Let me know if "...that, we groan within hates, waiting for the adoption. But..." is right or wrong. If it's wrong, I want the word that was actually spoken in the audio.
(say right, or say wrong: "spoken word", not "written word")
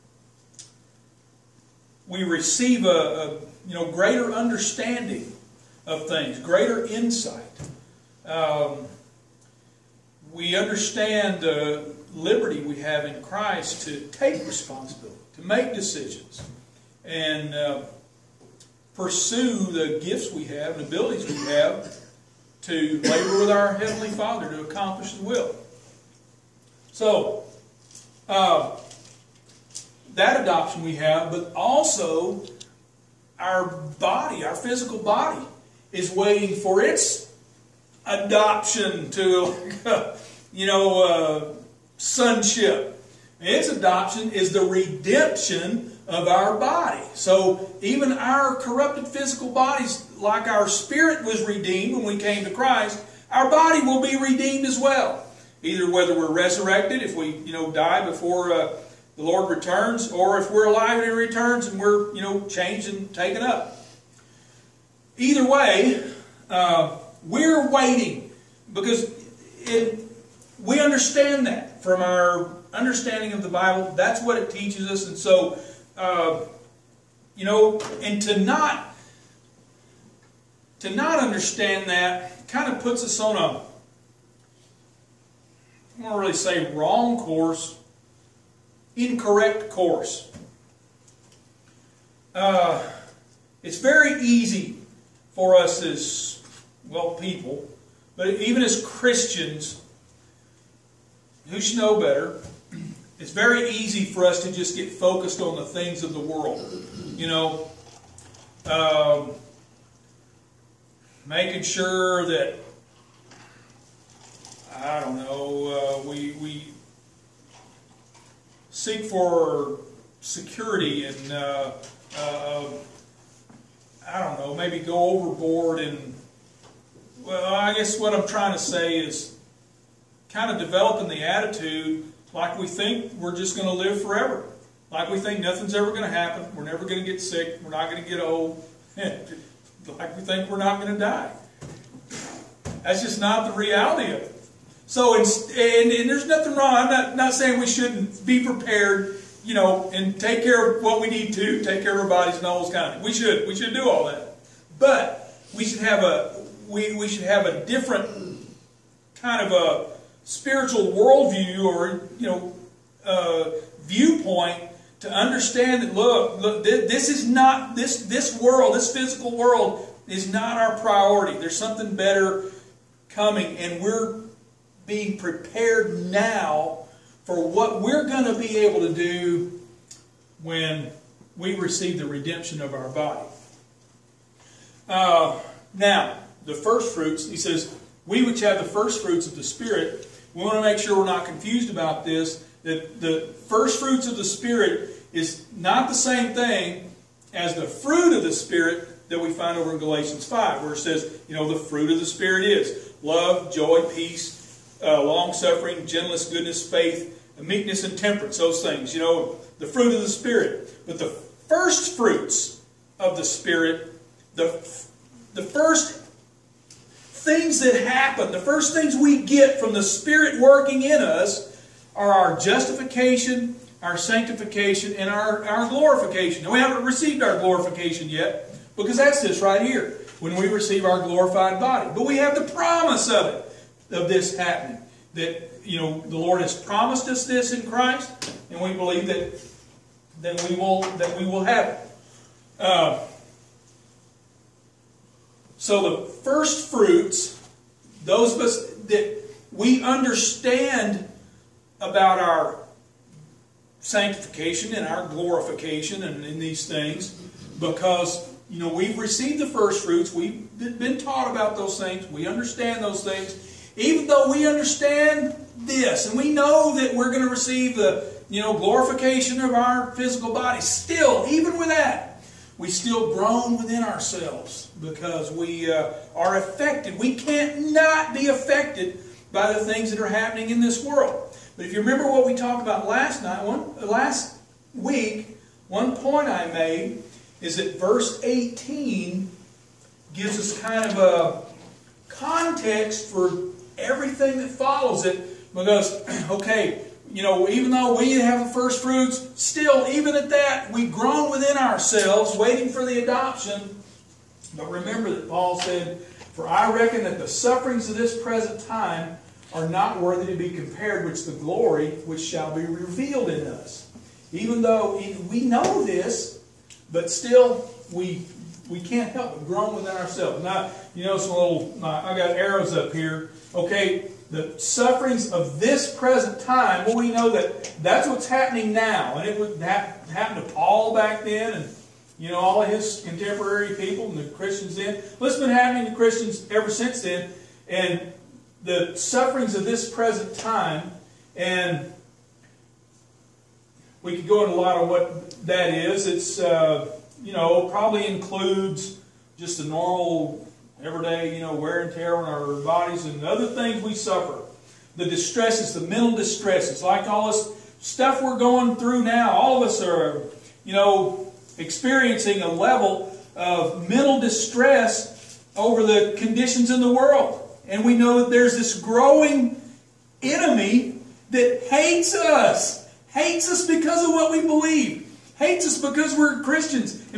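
wrong: "ourselves", not "hates".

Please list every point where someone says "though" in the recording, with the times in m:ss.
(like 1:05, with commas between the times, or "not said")
4:24, 4:57, 5:14.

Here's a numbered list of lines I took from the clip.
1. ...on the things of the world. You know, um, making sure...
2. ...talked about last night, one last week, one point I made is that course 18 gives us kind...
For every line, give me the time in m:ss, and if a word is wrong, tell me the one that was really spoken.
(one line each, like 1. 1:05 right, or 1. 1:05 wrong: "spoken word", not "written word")
1. 1:45 right
2. 4:42 wrong: "verse", not "course".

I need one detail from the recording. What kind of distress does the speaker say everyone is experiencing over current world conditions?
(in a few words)
Mental distress.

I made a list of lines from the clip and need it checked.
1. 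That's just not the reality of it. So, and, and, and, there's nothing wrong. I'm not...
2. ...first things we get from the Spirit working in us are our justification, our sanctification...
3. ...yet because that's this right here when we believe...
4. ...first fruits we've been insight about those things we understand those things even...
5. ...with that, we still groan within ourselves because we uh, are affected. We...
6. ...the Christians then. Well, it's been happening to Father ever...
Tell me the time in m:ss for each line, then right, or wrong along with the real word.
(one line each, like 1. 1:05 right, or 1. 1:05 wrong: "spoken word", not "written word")
1. 2:22 right
2. 3:38 right
3. 3:48 wrong: "receive", not "believe"
4. 4:19 wrong: "taught", not "insight"
5. 4:31 right
6. 5:34 wrong: "Christians", not "Father".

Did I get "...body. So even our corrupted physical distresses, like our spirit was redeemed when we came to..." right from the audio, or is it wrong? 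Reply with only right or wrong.
wrong.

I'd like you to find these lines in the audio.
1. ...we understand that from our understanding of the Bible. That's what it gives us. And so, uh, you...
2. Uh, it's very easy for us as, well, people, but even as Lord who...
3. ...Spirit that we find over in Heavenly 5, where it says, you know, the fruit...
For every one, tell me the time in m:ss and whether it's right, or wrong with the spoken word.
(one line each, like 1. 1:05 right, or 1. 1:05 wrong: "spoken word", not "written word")
1. 1:10 wrong: "teaches", not "gives"
2. 1:32 wrong: "Christians", not "Lord"
3. 3:18 wrong: "Galatians", not "Heavenly".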